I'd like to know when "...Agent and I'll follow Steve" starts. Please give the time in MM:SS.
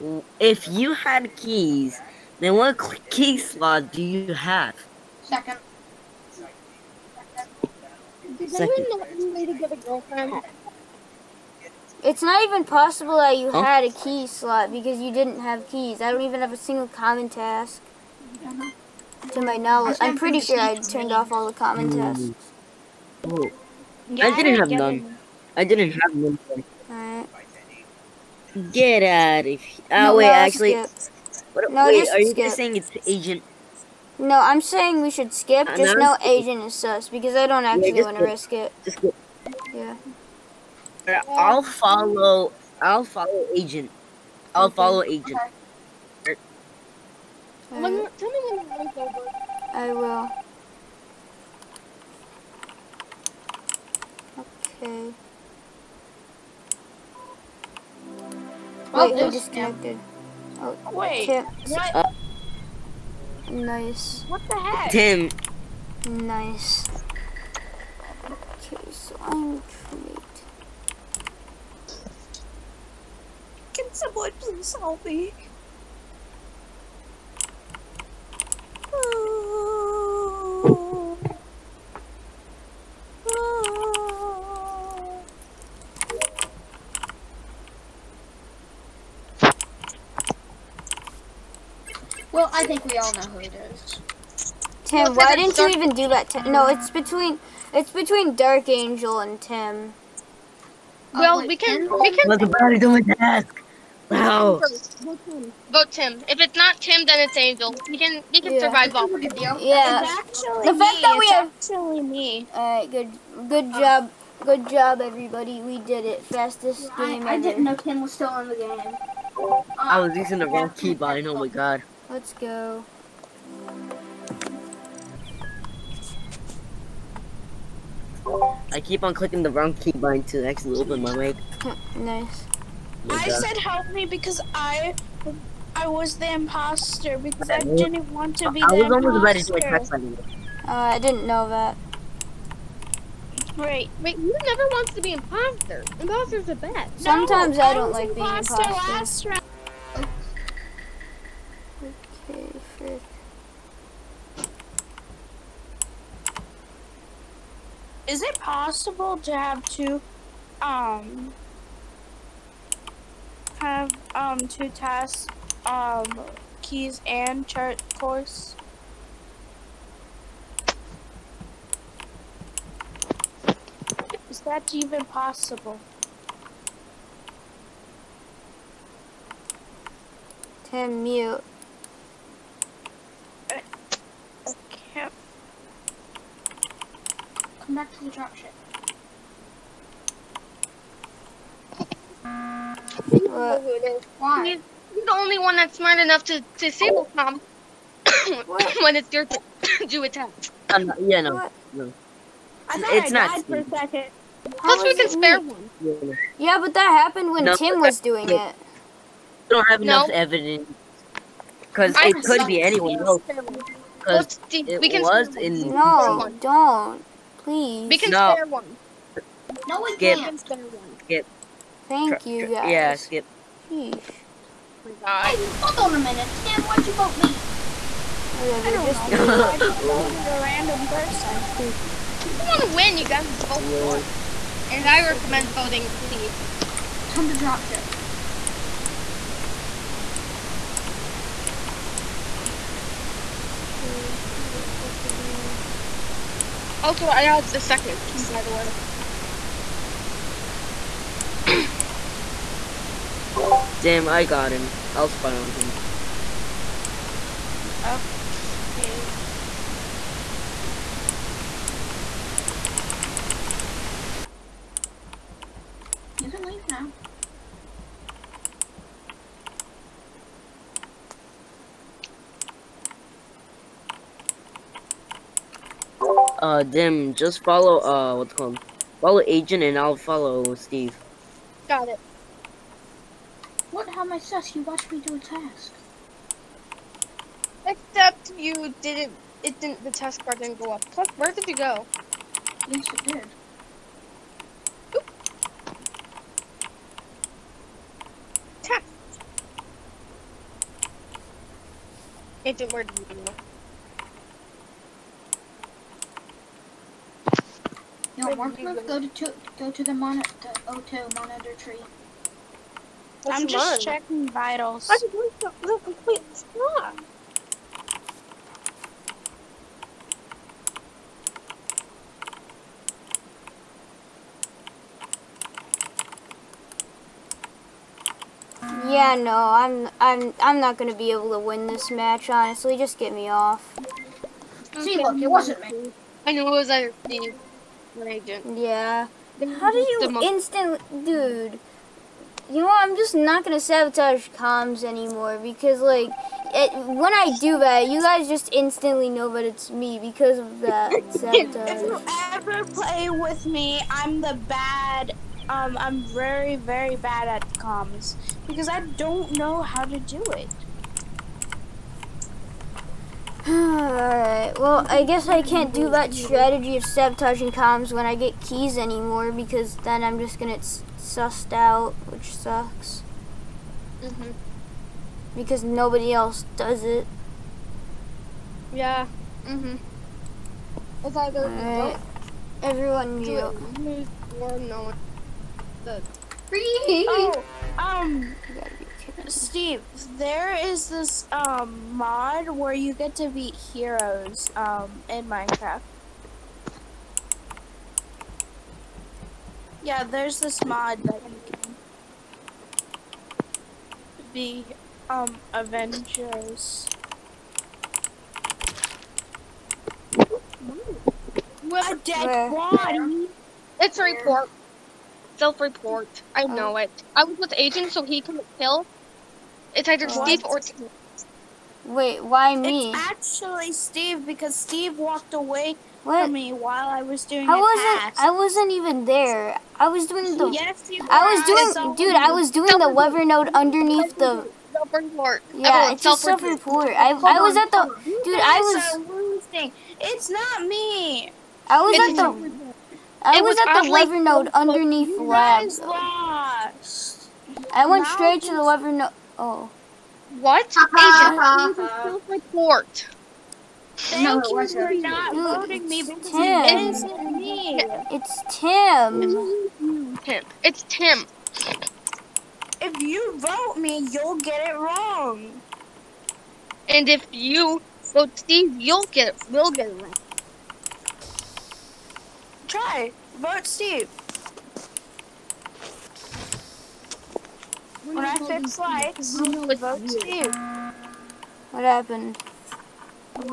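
04:39.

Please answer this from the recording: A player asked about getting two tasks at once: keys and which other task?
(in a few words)
Chart course.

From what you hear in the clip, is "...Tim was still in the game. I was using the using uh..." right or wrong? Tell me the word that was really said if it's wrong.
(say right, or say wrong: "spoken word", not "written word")
wrong: "wrong", not "using".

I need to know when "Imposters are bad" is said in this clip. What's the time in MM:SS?
02:25.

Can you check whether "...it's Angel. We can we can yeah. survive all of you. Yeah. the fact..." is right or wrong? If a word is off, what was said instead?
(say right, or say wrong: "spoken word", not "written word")
right.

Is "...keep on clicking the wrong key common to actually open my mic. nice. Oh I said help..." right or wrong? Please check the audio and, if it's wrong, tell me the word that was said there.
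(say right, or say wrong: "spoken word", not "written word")
wrong: "button", not "common".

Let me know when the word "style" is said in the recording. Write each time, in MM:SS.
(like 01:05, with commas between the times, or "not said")
not said.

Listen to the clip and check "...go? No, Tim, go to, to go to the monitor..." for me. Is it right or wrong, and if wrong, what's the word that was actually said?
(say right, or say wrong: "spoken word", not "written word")
wrong: "Warmproof", not "Tim".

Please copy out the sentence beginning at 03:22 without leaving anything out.
I thought it's I not died Steve.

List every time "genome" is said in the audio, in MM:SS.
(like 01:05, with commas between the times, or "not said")
not said.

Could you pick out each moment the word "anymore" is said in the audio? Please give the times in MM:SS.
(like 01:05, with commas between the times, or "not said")
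05:44, 06:08.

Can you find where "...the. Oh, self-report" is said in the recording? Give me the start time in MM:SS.
07:14.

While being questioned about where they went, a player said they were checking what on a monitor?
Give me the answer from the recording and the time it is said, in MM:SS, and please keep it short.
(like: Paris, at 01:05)
Vitals, at 05:13.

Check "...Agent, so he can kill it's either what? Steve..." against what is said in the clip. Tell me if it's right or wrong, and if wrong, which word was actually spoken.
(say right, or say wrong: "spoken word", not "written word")
right.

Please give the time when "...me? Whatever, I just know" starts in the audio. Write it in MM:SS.
03:47.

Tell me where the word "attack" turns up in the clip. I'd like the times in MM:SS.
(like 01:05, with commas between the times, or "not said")
02:19, 03:20.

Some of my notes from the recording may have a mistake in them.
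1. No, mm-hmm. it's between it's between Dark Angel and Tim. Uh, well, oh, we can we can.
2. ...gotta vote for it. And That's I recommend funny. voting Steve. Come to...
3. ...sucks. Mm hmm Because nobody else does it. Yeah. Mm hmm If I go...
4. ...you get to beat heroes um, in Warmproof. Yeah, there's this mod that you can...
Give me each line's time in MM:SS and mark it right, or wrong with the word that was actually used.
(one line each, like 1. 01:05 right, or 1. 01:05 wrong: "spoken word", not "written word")
1. 01:36 right
2. 03:53 right
3. 06:12 right
4. 06:32 wrong: "Minecraft", not "Warmproof".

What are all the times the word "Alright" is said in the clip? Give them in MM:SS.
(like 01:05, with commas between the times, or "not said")
00:26, 06:03.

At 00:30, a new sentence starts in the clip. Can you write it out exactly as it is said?
What, no, wait, are you skip.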